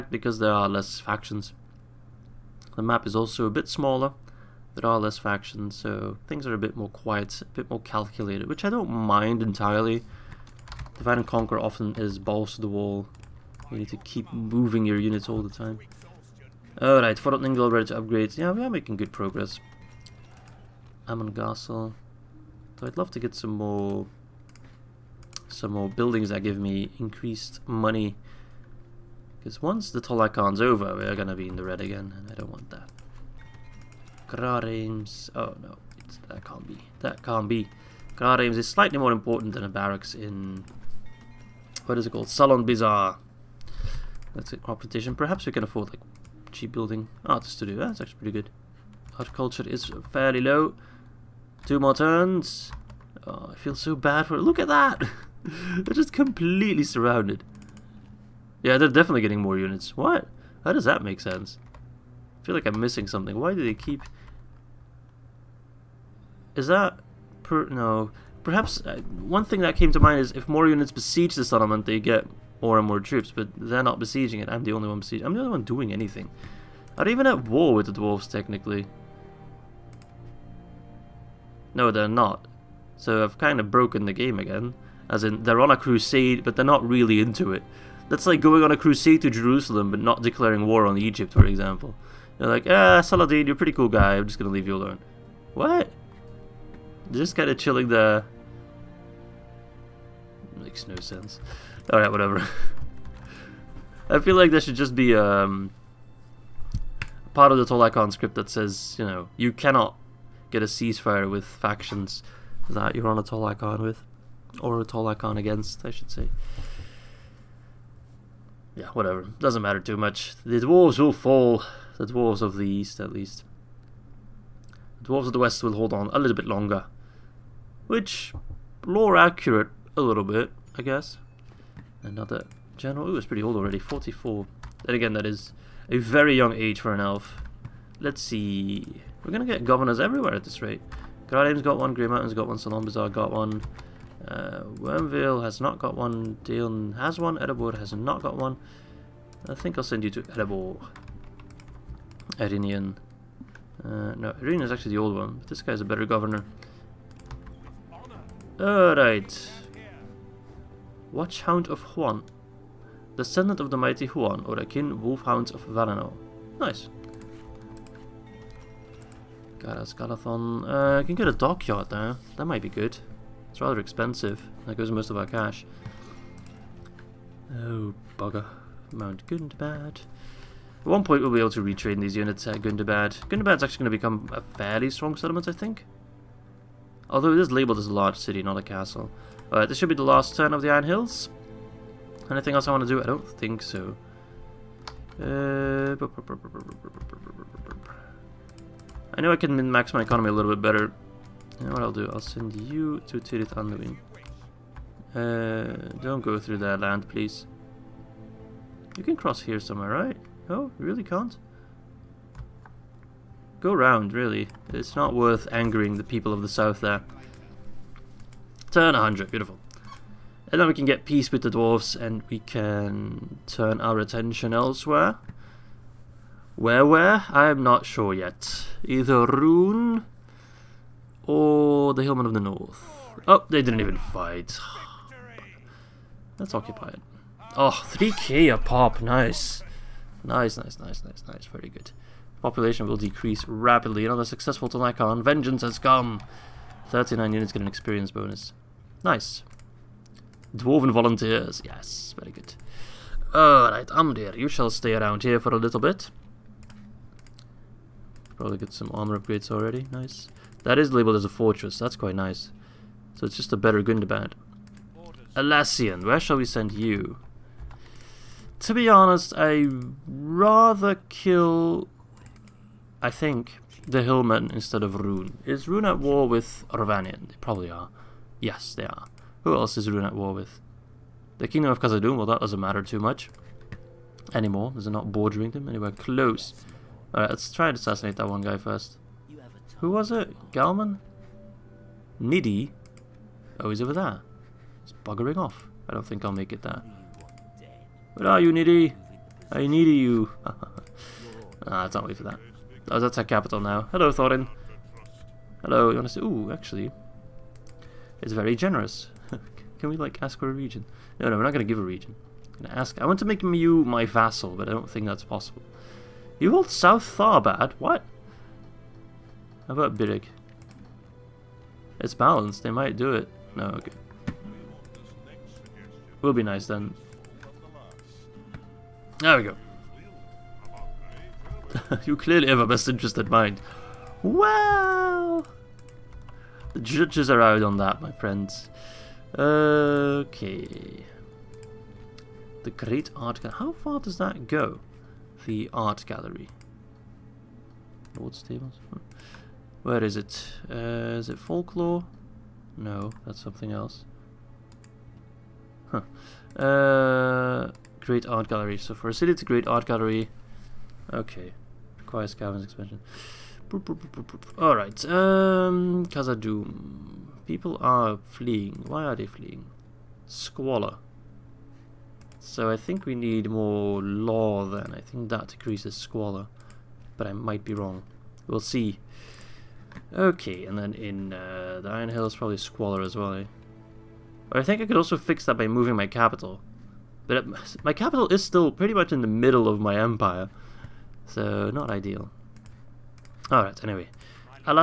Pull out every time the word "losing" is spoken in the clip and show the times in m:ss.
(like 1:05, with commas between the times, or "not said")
not said.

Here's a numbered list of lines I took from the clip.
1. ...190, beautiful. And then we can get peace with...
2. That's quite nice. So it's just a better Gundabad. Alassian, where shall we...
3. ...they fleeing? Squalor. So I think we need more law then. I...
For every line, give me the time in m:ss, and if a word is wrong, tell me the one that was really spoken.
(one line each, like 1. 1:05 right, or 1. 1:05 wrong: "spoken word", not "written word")
1. 3:38 wrong: "100", not "190"
2. 4:21 right
3. 6:09 right.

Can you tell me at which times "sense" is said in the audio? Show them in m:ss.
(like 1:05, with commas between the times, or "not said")
1:01, 1:40.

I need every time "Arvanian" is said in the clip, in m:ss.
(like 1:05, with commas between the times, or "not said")
4:36.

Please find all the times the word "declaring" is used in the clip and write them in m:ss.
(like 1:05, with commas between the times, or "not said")
1:30.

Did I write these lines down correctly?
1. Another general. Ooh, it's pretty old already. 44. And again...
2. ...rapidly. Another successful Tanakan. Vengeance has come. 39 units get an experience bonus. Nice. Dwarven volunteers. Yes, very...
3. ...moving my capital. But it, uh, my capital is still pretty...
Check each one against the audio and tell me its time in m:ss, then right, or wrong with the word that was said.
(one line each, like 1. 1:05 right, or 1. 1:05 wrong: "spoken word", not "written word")
1. 2:12 right
2. 4:03 right
3. 6:25 right.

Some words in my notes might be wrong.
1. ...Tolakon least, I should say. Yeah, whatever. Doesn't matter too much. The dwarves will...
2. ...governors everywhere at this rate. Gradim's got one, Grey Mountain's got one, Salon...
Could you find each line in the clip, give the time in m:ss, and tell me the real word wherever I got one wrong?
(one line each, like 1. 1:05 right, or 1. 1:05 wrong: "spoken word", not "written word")
1. 1:54 wrong: "against", not "least"
2. 2:19 right.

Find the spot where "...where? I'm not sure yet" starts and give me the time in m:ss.
3:46.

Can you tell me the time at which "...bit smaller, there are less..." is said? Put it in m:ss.
0:03.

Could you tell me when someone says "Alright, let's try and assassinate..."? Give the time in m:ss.
4:47.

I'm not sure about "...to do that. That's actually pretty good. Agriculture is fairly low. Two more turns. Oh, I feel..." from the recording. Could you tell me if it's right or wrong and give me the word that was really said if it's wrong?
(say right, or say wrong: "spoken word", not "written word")
right.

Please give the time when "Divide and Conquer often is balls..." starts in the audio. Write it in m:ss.
0:10.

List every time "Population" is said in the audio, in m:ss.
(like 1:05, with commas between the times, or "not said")
4:02.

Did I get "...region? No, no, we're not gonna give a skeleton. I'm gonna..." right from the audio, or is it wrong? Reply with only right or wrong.
wrong.